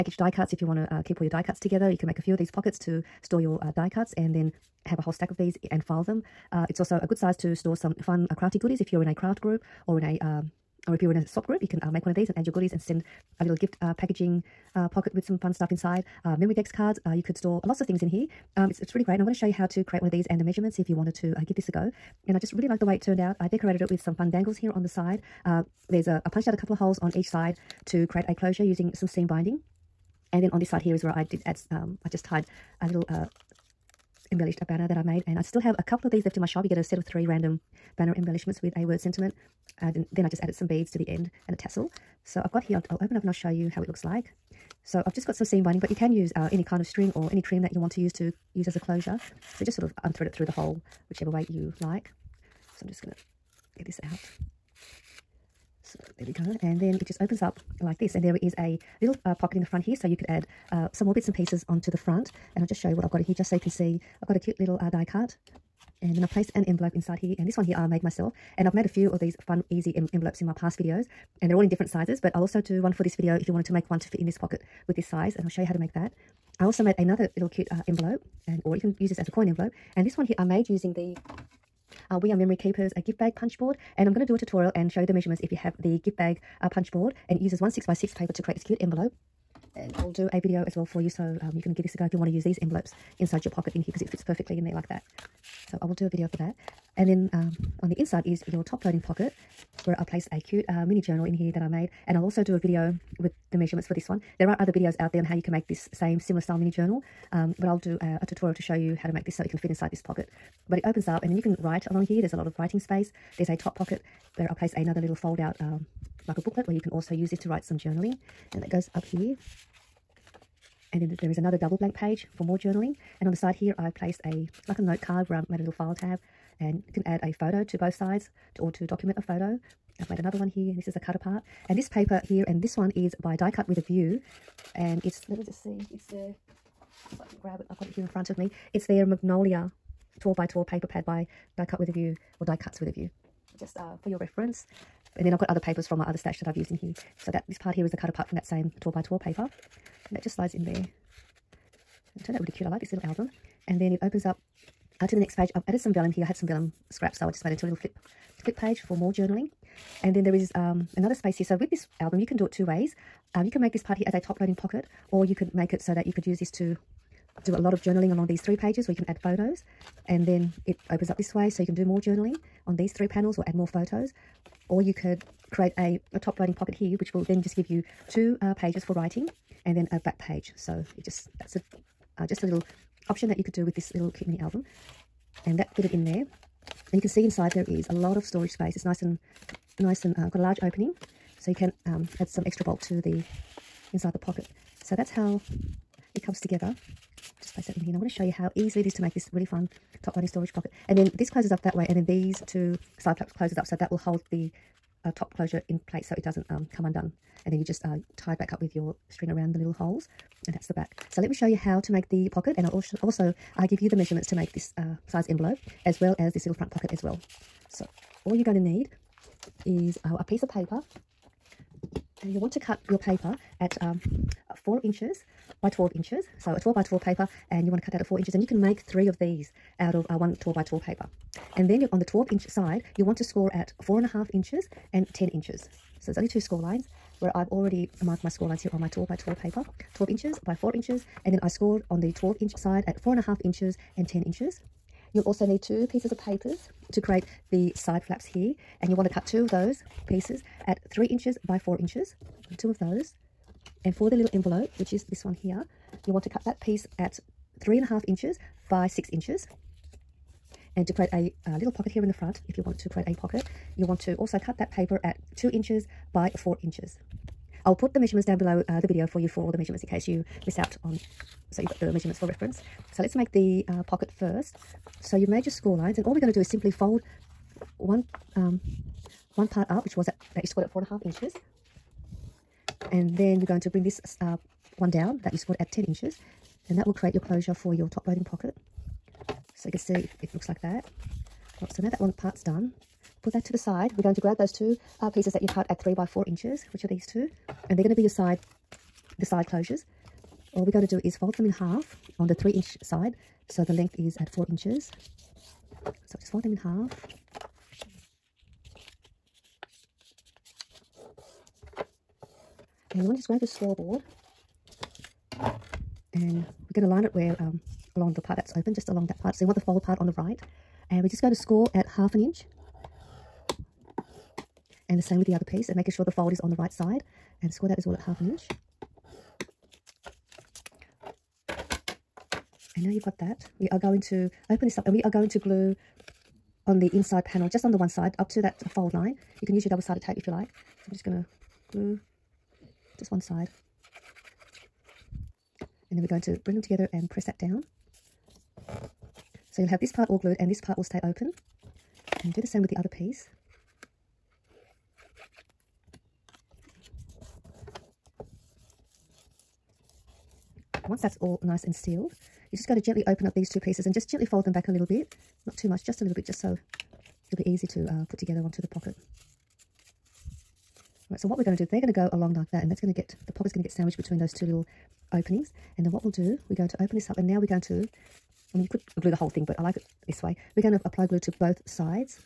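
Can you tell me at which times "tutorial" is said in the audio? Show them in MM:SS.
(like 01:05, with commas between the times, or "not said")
01:24, 01:48.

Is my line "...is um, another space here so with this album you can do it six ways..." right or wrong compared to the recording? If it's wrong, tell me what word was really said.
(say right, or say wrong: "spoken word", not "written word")
wrong: "two", not "six".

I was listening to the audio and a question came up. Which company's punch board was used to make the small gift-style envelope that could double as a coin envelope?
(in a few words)
We Are Memory Keepers.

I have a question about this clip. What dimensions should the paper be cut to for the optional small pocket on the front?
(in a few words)
2 by 4 inches.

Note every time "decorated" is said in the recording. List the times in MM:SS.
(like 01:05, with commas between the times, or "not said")
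00:23.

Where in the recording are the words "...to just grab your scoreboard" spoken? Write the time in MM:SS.
05:13.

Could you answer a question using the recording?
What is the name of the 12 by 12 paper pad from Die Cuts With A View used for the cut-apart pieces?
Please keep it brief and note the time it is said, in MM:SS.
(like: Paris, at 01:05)
Magnolia, at 02:19.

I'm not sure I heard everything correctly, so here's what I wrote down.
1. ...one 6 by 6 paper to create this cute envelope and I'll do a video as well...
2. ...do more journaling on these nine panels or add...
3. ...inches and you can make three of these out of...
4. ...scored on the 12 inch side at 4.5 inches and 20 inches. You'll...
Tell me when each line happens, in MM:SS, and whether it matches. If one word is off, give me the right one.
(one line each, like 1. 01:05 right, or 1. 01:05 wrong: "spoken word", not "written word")
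1. 01:27 right
2. 02:51 wrong: "three", not "nine"
3. 03:48 right
4. 04:01 wrong: "10", not "20".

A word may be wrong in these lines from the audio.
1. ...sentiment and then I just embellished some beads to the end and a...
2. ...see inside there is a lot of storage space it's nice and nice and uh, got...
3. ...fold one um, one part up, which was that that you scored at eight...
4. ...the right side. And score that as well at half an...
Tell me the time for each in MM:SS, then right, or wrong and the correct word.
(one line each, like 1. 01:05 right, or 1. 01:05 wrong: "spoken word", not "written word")
1. 00:38 wrong: "added", not "embellished"
2. 03:07 right
3. 04:36 wrong: "four", not "eight"
4. 05:26 right.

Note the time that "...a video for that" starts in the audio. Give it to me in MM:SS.
01:36.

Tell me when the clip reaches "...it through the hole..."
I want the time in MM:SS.
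00:50.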